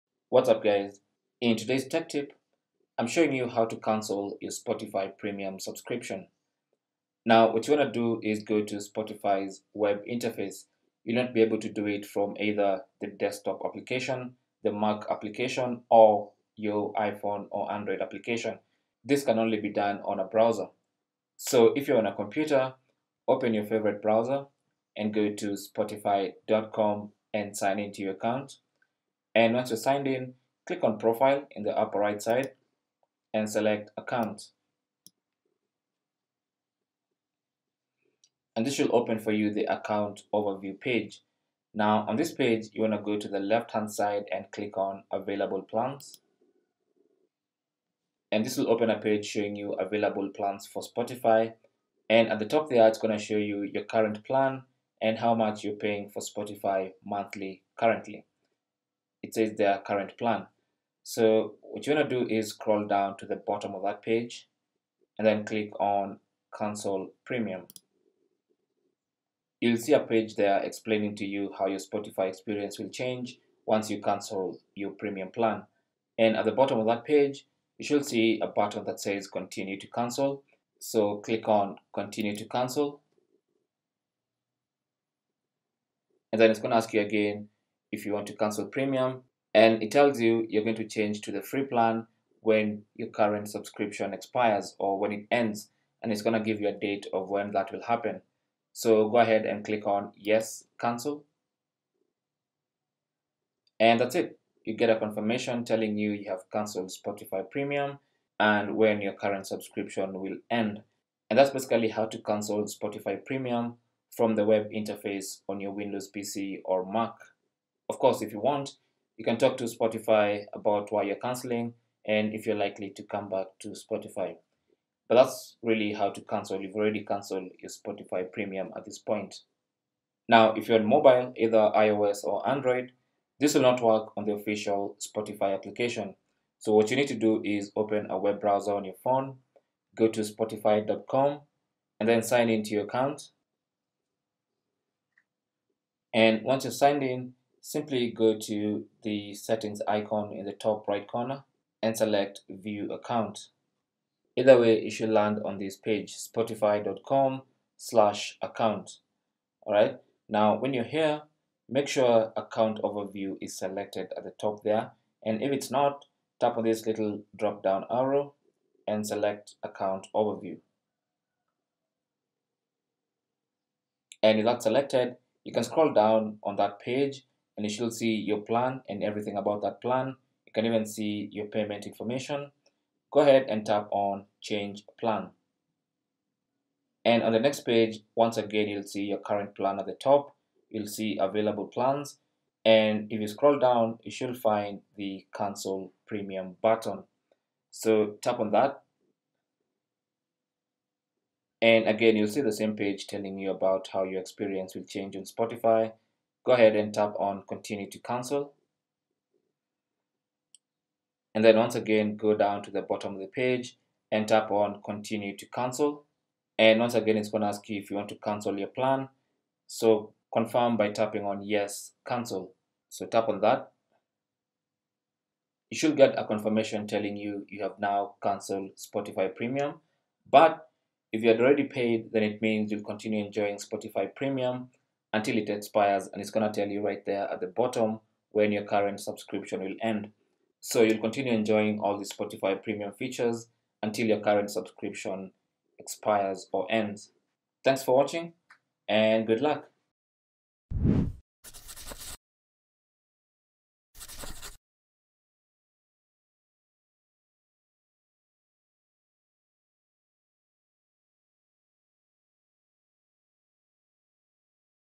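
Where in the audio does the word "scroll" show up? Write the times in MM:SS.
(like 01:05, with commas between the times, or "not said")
01:02, 02:55, 03:13.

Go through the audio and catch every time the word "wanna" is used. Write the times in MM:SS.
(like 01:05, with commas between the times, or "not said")
00:42.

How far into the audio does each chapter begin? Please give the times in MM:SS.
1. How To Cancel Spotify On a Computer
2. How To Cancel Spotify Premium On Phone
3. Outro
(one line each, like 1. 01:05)
1. 00:20
2. 02:10
3. 04:07.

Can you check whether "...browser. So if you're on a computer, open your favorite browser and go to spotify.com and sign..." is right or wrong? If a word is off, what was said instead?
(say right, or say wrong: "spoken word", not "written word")
right.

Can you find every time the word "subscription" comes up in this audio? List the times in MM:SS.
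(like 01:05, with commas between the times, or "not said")
00:05, 01:33, 01:49, 03:58, 04:04.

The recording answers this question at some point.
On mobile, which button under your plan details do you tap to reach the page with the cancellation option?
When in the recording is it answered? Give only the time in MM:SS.
03:04.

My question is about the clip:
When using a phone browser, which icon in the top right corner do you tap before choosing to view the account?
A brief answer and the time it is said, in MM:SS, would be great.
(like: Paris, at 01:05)
Settings icon, at 02:29.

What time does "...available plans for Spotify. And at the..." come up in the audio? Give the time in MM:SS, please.
00:49.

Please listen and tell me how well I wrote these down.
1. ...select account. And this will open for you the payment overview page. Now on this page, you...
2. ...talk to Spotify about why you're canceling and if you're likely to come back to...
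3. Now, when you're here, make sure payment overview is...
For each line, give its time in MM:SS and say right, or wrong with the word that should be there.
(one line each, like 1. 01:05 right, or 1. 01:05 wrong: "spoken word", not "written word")
1. 00:33 wrong: "account", not "payment"
2. 01:59 right
3. 02:40 wrong: "account", not "payment".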